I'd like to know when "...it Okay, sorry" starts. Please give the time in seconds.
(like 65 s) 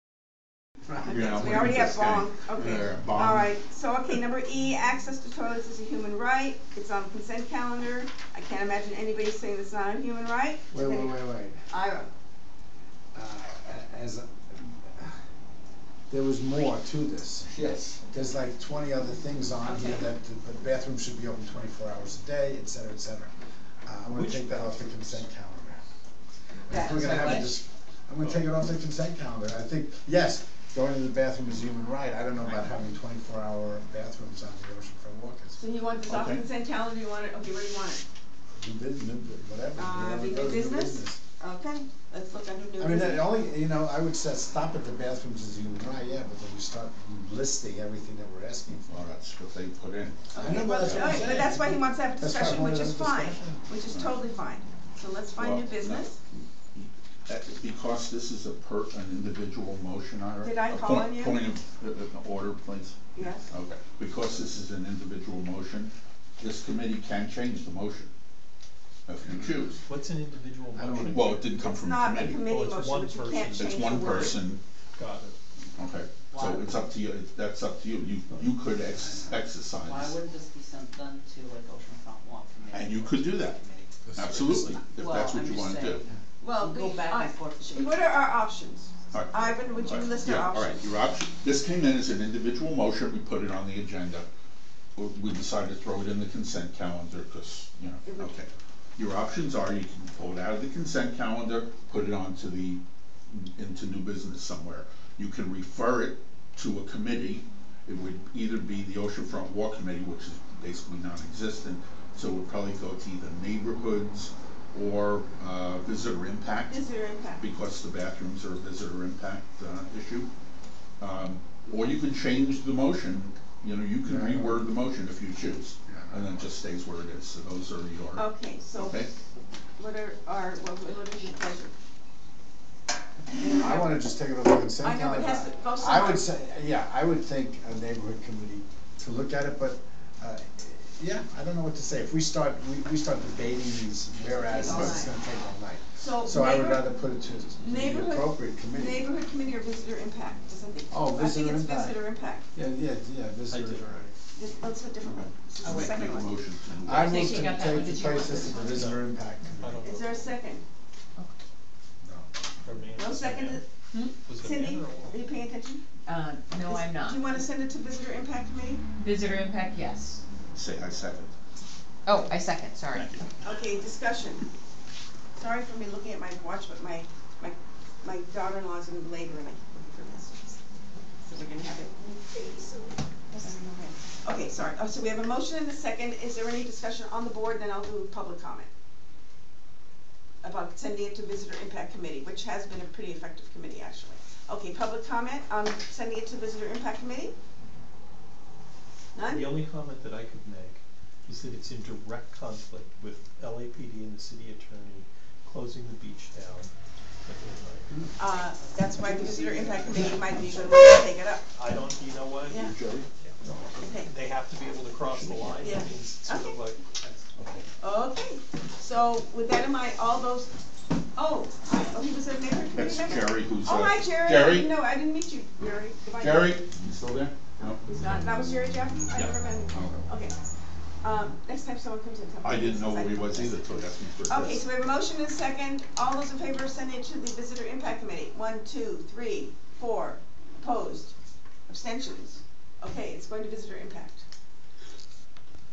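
183 s.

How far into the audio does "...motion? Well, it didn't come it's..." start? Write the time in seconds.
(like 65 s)
70 s.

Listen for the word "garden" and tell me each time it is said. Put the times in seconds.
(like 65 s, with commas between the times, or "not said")
not said.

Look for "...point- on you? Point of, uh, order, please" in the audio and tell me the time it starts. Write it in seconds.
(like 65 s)
60 s.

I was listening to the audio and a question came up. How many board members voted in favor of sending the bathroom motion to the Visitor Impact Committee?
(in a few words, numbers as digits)
4.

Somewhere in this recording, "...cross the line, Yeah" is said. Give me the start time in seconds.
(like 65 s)
214 s.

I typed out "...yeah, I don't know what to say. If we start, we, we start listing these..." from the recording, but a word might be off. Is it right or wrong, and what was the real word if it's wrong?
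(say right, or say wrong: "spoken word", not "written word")
wrong: "debating", not "listing".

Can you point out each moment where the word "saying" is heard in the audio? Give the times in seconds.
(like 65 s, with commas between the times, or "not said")
9 s, 85 s.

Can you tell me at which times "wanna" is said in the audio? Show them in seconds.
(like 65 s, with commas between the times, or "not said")
85 s, 133 s, 167 s.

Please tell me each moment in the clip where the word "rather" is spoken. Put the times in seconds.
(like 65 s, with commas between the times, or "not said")
146 s.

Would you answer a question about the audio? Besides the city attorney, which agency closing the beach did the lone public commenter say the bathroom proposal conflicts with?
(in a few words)
LAPD.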